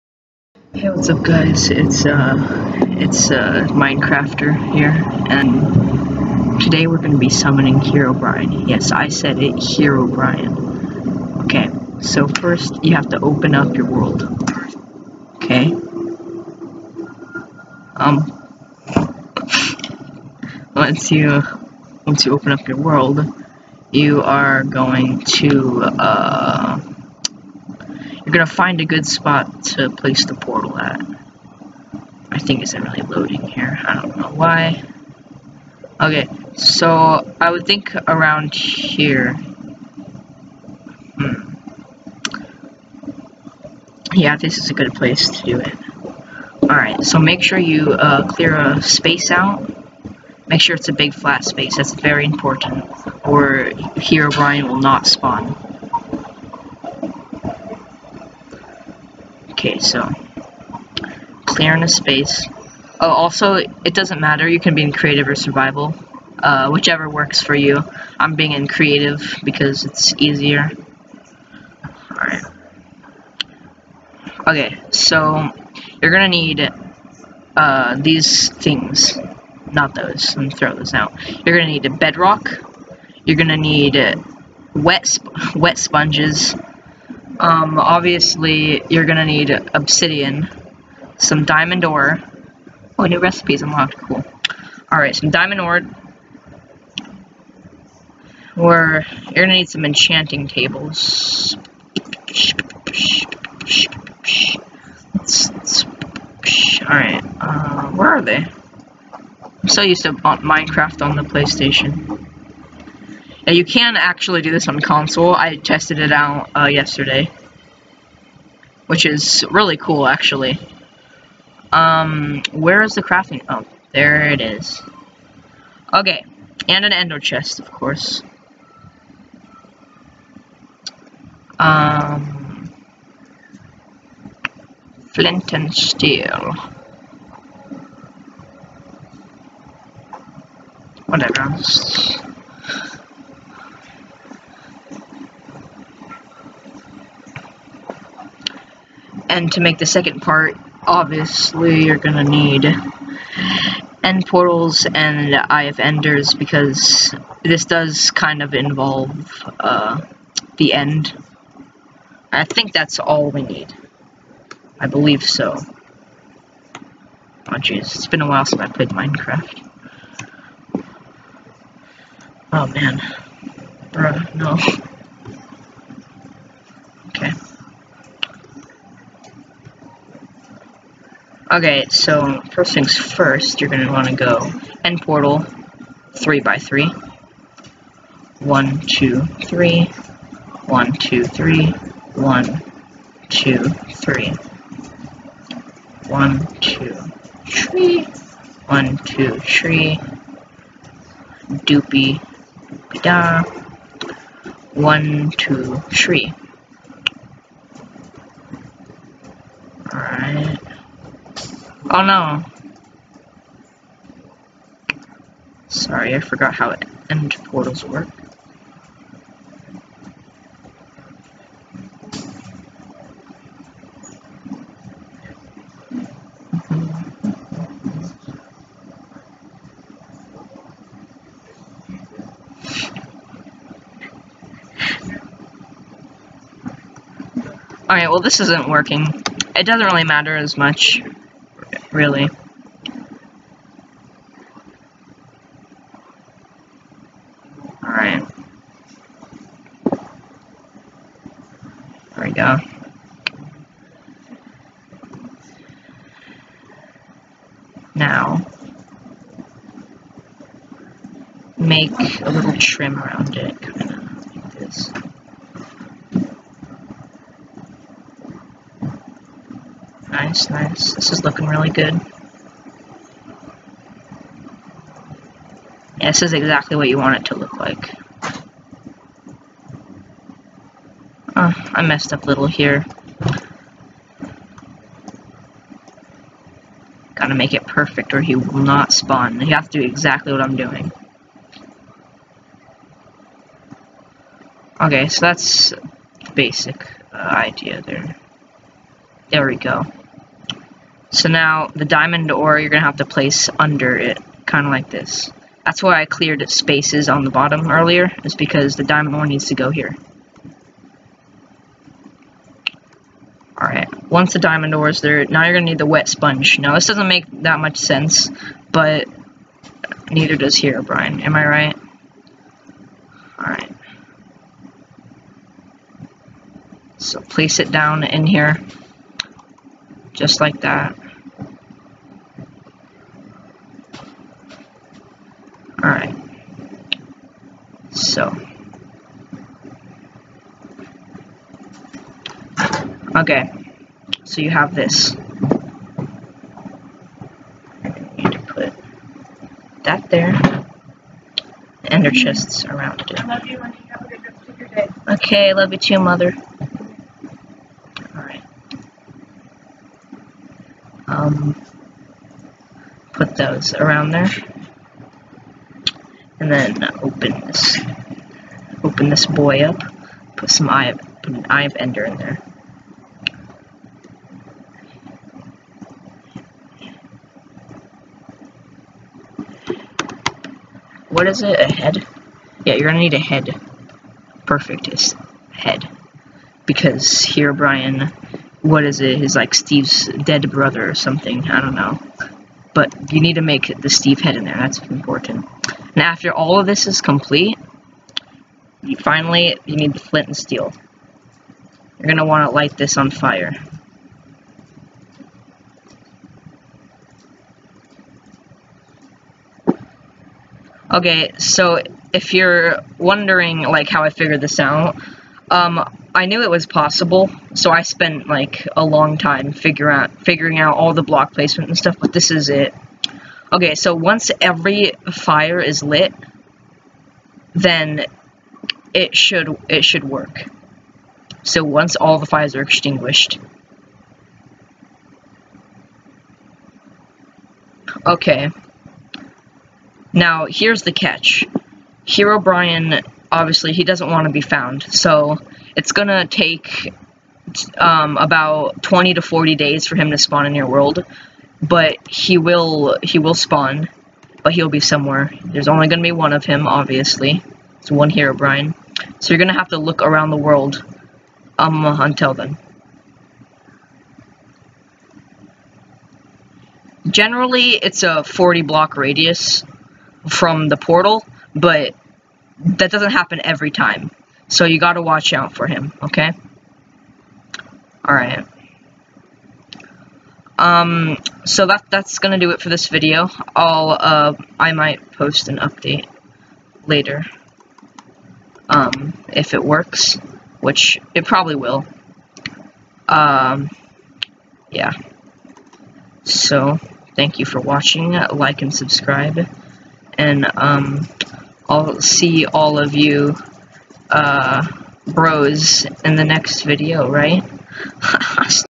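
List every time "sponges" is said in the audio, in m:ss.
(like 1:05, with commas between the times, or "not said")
1:25, 5:16.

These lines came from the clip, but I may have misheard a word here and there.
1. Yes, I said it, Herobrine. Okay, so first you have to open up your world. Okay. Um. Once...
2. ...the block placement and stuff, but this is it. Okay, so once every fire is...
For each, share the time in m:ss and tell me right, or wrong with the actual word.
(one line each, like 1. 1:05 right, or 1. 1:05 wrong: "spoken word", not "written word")
1. 0:08 right
2. 7:00 right.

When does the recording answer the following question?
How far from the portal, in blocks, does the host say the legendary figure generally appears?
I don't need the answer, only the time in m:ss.
7:48.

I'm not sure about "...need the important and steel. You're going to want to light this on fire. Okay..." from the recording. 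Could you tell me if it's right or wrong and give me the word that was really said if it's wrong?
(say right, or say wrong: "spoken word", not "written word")
wrong: "flint", not "important".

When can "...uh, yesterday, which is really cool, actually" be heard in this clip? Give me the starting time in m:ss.
1:56.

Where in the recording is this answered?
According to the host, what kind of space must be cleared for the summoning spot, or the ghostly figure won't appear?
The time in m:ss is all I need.
0:50.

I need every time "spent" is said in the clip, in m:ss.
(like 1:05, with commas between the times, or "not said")
6:57.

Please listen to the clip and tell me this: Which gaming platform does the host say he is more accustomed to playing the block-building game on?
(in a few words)
PlayStation.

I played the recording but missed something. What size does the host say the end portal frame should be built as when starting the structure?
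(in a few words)
3 by 3.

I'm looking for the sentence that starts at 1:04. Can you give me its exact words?
You can be in creative or survival, uh, whichever works for you.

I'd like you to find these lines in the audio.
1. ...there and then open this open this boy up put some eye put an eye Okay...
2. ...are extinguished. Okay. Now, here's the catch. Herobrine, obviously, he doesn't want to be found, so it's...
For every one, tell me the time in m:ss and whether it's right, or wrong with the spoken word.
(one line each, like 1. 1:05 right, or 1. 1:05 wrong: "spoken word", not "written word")
1. 6:04 wrong: "Ender", not "Okay"
2. 7:12 right.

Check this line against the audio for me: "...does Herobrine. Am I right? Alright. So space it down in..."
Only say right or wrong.
wrong.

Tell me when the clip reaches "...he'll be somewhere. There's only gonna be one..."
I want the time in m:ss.
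7:34.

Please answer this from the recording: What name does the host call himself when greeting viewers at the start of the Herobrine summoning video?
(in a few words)
Minecrafter.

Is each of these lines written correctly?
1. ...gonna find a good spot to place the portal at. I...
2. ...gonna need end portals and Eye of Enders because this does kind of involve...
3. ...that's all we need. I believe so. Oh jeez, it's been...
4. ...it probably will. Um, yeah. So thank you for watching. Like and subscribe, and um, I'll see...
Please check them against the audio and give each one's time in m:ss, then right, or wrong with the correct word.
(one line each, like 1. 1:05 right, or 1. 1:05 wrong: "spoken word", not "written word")
1. 0:28 right
2. 2:32 right
3. 2:42 right
4. 8:11 right.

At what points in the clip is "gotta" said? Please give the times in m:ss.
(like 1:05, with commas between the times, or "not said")
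4:47, 7:54.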